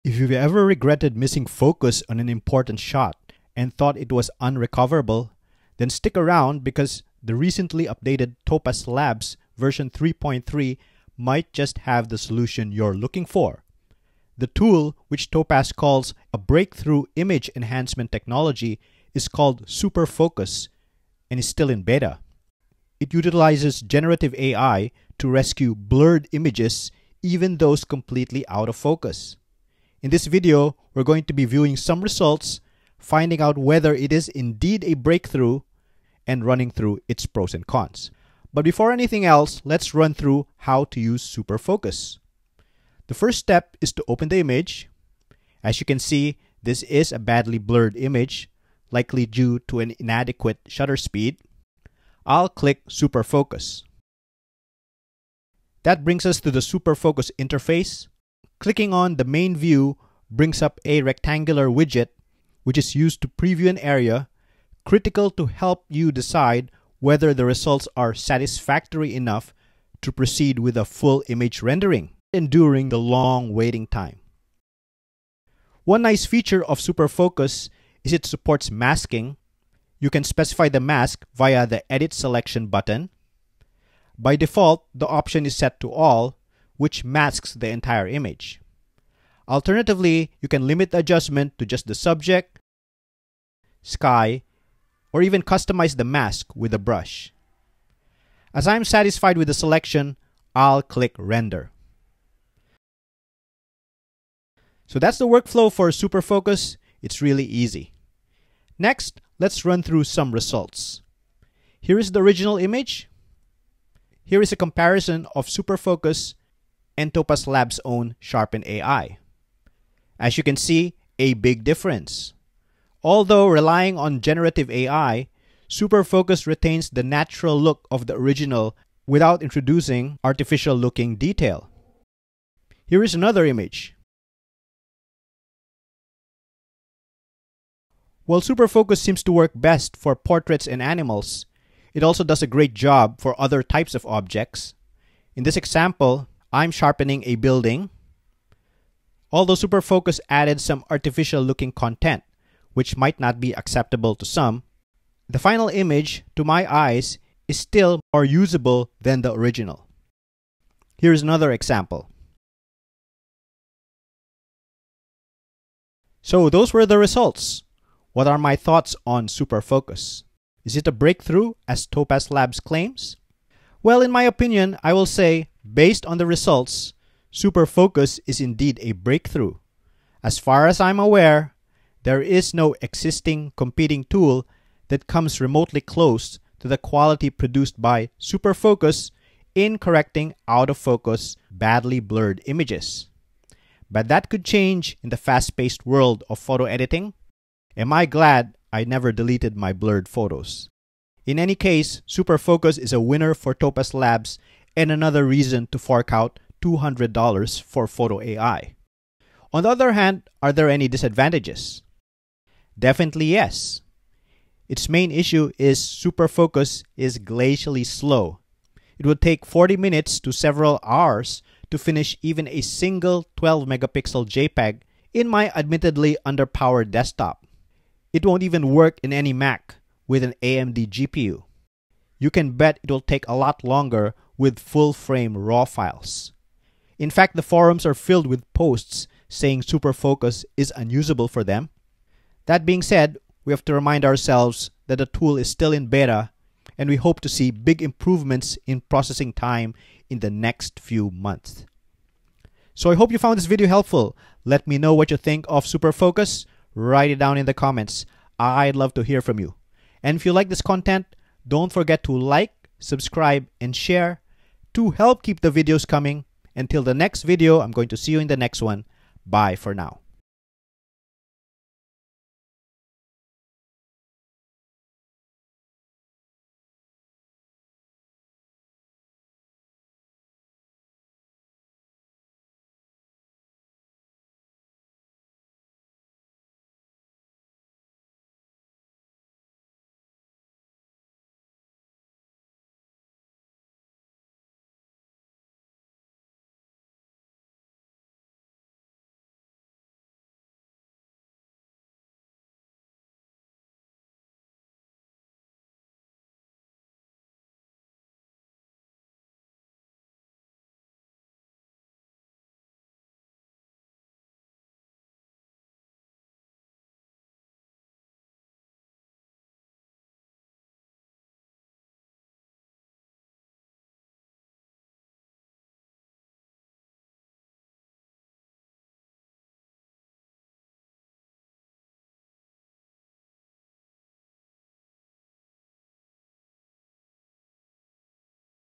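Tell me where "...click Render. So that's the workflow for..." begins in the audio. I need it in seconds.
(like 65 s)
100 s.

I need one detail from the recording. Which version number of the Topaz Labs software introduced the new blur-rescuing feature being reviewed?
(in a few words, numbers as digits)
3.3.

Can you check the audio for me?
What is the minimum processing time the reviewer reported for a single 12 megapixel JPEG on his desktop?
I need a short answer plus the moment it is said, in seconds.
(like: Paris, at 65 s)
40 minutes, at 219 s.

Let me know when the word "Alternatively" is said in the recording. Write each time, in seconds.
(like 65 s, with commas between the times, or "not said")
89 s.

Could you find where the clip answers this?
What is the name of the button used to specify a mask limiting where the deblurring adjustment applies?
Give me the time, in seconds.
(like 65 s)
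81 s.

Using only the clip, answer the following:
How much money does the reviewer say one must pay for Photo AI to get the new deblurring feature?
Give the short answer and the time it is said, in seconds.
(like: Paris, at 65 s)
$200, at 206 s.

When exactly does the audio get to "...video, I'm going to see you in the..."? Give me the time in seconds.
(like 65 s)
267 s.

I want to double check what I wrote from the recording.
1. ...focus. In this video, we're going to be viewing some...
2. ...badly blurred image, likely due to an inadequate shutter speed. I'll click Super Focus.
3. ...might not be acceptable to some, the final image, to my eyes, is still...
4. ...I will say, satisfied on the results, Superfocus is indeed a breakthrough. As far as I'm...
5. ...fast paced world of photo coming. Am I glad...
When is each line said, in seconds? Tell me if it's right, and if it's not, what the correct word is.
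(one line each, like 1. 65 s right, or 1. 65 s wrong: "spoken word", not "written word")
1. 28 s right
2. 47 s right
3. 152 s right
4. 174 s wrong: "based", not "satisfied"
5. 195 s wrong: "editing", not "coming".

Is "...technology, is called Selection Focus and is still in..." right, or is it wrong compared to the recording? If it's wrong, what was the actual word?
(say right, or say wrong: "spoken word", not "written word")
wrong: "Super", not "Selection".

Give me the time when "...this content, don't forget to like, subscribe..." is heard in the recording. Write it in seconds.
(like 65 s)
260 s.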